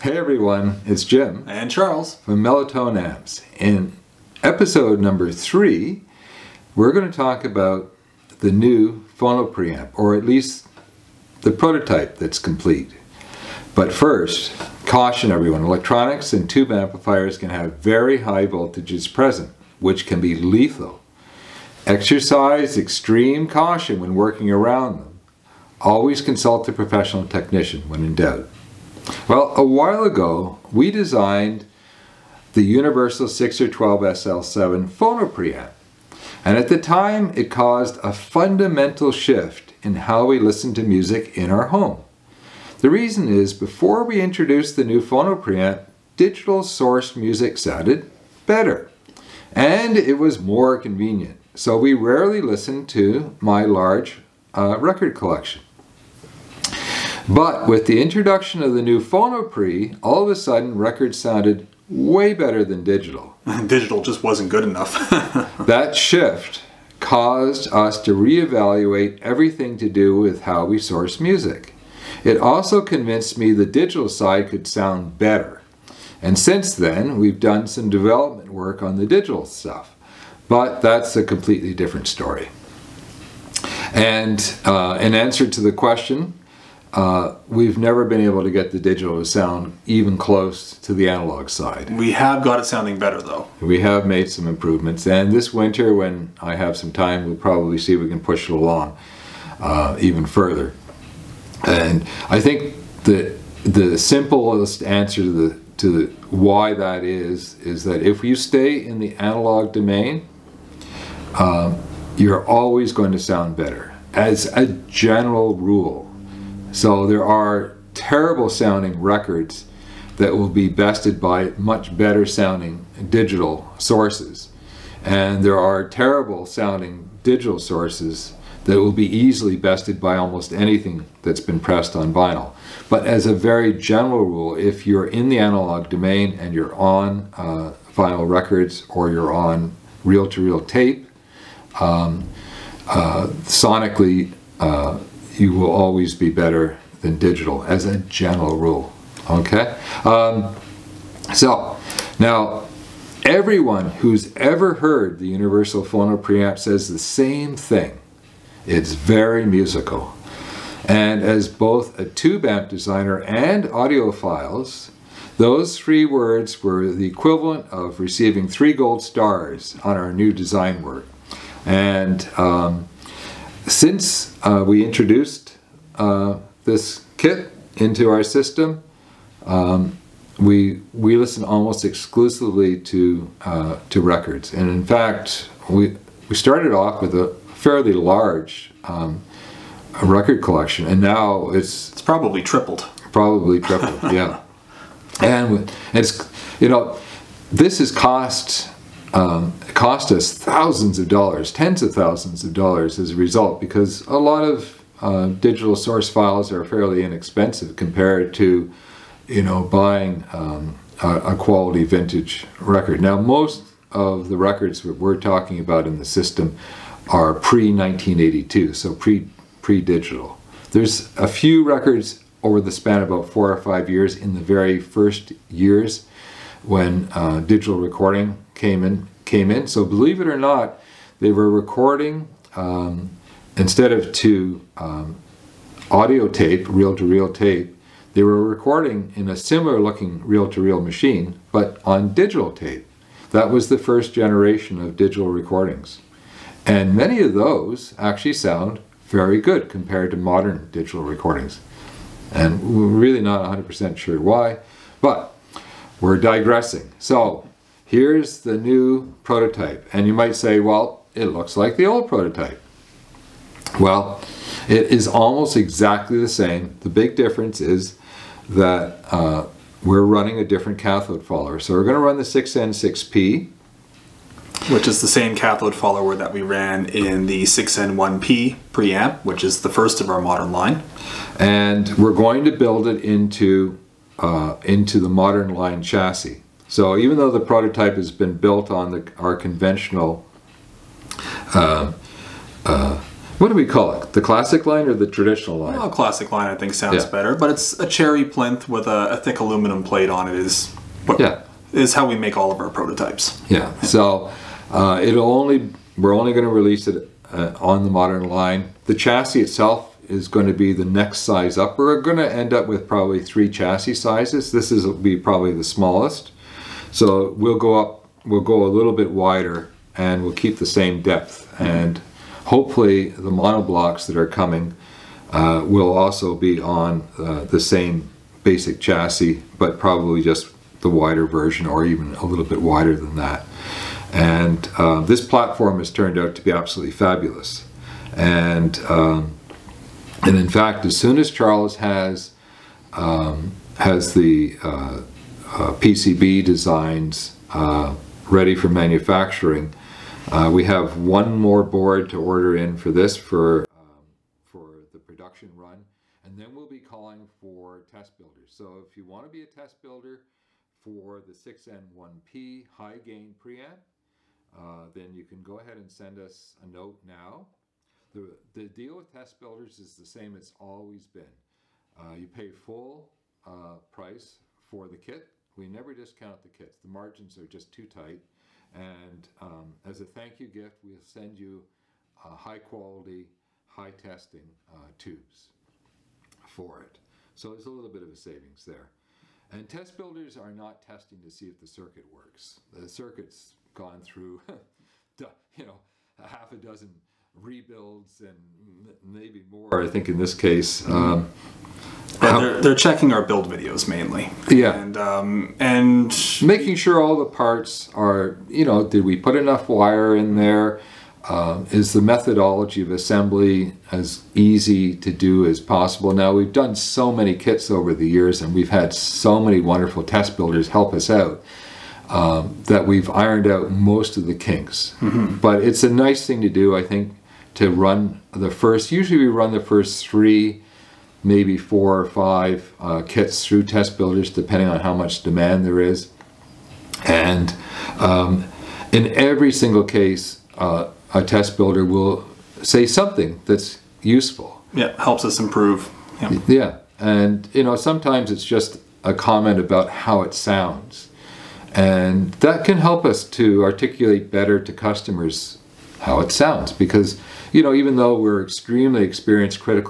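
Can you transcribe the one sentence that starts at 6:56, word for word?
Now, we've done so many kits over the years and we've had so many wonderful test builders help us out.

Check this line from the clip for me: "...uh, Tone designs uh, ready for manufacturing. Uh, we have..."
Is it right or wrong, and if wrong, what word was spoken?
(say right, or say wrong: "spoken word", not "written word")
wrong: "PCB", not "Tone".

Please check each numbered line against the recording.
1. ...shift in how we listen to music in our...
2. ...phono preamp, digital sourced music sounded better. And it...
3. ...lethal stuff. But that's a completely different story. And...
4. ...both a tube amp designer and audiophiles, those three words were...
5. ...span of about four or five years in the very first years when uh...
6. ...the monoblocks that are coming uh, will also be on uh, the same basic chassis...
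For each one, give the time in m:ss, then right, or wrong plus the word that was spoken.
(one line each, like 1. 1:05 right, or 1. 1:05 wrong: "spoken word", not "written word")
1. 0:39 right
2. 0:45 right
3. 1:19 wrong: "digital", not "lethal"
4. 2:41 right
5. 3:42 right
6. 5:23 right.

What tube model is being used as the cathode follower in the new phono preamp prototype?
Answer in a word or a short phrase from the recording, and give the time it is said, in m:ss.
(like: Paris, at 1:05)
6N6P, at 4:32.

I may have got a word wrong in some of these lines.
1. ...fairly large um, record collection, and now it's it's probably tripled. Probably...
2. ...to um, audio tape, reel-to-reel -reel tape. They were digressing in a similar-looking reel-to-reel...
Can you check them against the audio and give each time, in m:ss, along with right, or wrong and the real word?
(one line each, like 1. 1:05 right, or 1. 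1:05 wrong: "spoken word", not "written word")
1. 3:07 right
2. 3:54 wrong: "recording", not "digressing".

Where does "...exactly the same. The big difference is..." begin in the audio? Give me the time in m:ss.
4:25.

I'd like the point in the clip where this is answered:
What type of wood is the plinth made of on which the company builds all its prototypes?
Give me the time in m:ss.
4:57.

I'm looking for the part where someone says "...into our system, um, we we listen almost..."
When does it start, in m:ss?
2:57.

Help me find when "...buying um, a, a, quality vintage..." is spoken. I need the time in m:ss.
3:29.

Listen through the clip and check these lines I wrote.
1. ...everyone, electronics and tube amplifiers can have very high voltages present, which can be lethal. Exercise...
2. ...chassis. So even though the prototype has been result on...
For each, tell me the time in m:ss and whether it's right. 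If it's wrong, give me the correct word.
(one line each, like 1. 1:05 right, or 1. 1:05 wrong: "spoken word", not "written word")
1. 0:15 right
2. 4:45 wrong: "built", not "result".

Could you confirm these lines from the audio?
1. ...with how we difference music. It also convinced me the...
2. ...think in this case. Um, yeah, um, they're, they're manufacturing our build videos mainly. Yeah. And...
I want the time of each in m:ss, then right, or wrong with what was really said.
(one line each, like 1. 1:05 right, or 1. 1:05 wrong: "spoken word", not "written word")
1. 1:10 wrong: "source", not "difference"
2. 6:39 wrong: "checking", not "manufacturing".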